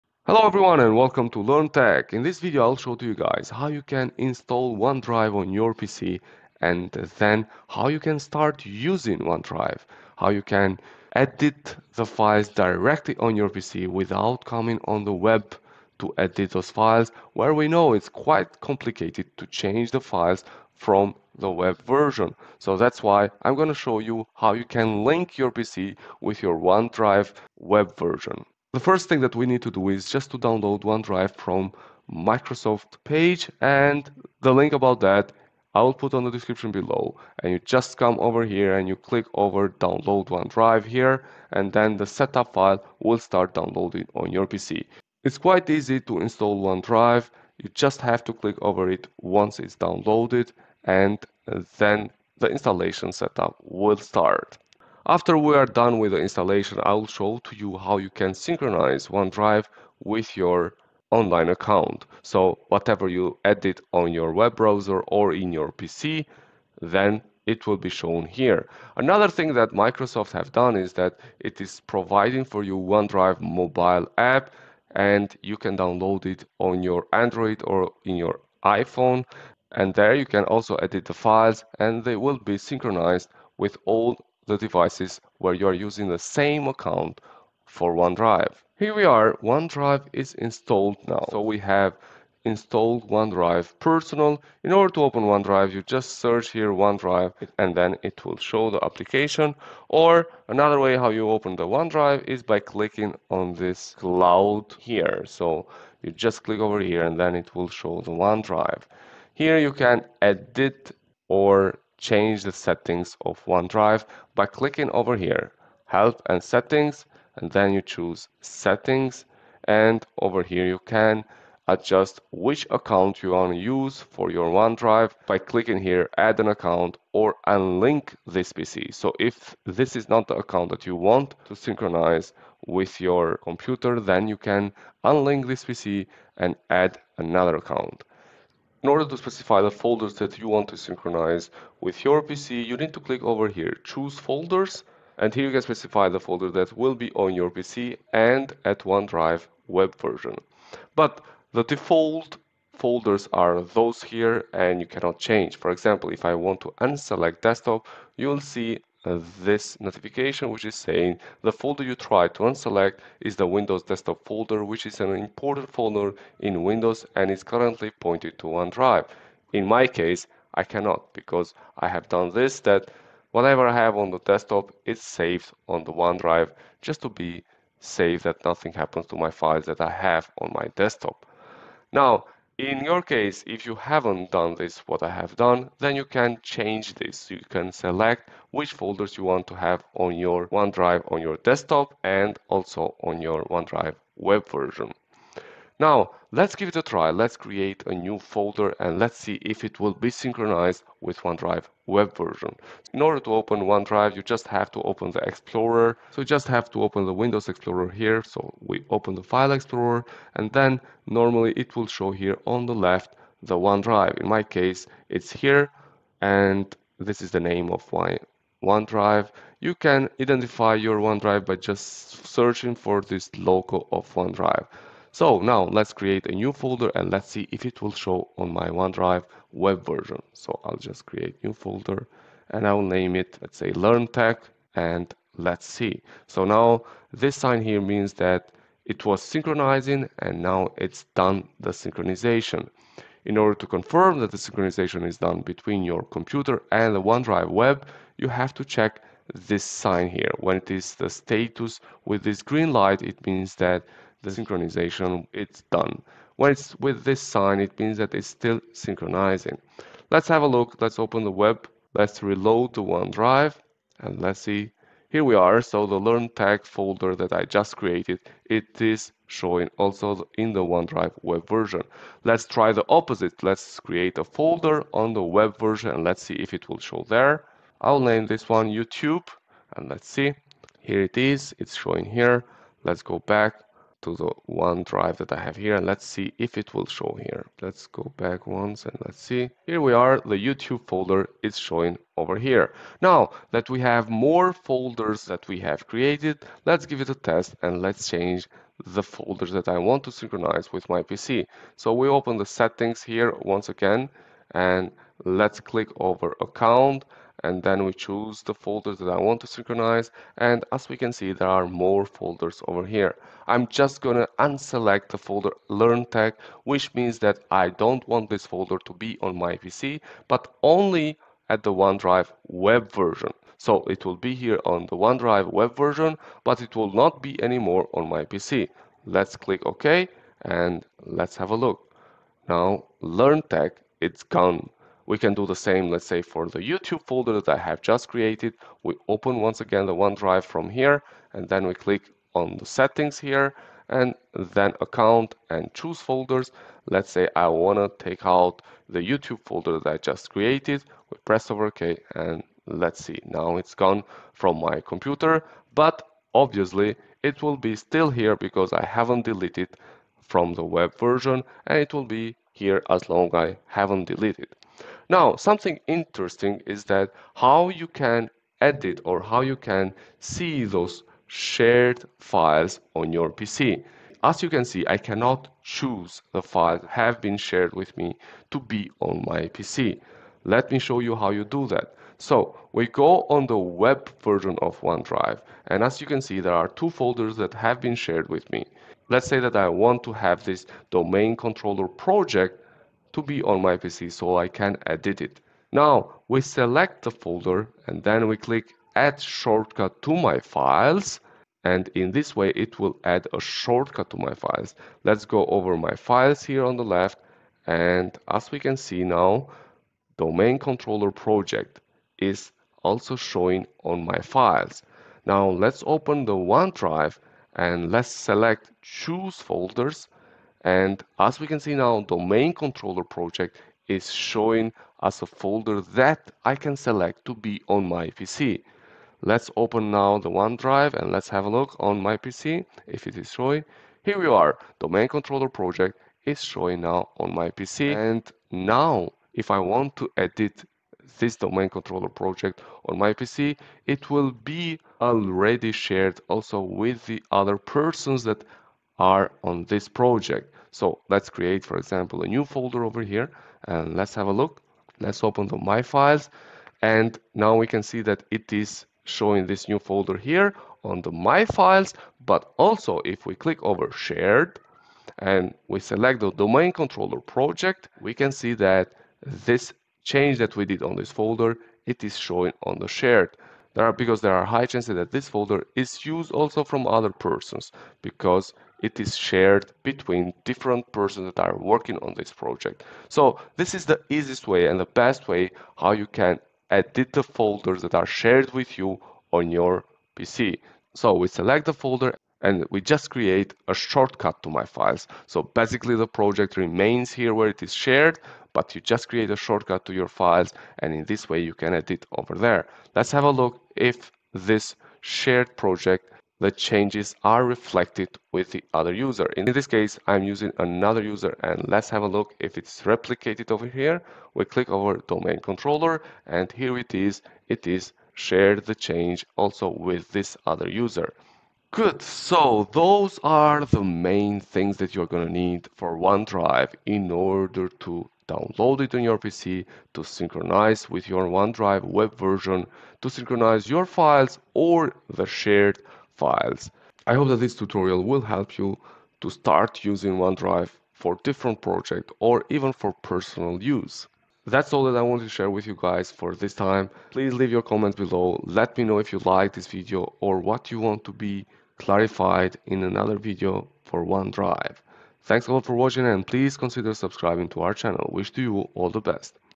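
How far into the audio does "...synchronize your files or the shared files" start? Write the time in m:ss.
8:53.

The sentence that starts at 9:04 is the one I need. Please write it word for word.
That's all that I wanted to share with you guys for this time.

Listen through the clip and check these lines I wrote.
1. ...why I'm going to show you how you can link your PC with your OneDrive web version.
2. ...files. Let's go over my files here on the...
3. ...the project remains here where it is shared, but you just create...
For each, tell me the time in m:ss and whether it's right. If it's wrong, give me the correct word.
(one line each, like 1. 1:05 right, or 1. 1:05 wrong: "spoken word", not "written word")
1. 0:23 right
2. 6:44 right
3. 8:15 right.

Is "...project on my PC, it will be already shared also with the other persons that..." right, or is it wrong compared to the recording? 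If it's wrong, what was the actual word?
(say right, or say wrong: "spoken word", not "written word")
right.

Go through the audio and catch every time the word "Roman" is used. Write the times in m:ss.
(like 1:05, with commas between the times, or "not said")
not said.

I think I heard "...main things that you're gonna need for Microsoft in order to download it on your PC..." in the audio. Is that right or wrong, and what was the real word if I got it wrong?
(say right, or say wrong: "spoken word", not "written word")
wrong: "OneDrive", not "Microsoft".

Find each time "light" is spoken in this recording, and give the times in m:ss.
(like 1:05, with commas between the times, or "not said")
4:12.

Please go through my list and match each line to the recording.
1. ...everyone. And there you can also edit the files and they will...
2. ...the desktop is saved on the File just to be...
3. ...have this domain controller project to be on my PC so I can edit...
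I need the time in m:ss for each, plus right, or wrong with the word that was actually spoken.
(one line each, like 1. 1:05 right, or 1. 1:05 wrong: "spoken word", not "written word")
1. 1:18 wrong: "iPhone", not "everyone"
2. 2:54 wrong: "OneDrive", not "File"
3. 6:30 right.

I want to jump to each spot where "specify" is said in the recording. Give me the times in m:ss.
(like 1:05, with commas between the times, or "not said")
2:19, 2:25.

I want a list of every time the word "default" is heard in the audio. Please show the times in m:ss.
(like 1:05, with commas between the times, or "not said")
2:31.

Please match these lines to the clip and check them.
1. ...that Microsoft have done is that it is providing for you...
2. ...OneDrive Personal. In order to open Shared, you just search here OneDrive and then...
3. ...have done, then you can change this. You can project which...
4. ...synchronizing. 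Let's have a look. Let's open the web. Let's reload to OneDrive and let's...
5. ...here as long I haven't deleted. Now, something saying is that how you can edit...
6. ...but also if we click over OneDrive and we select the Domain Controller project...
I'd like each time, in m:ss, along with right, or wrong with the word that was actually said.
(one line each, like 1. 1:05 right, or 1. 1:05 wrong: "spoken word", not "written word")
1. 1:09 right
2. 1:33 wrong: "OneDrive", not "Shared"
3. 3:05 wrong: "select", not "project"
4. 4:18 right
5. 6:02 wrong: "interesting", not "saying"
6. 7:42 wrong: "Shared", not "OneDrive".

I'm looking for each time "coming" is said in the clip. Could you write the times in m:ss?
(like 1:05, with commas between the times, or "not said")
0:14.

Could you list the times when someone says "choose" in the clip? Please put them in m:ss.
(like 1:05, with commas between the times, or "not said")
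1:57, 2:23, 5:07, 5:45, 6:15, 6:58.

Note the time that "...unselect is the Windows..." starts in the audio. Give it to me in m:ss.
2:42.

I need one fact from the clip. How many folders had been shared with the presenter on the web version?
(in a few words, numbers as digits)
2.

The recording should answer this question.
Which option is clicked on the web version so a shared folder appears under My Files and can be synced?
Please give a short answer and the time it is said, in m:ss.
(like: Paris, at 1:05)
add shortcut to my files, at 6:38.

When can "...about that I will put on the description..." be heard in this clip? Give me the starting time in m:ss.
0:34.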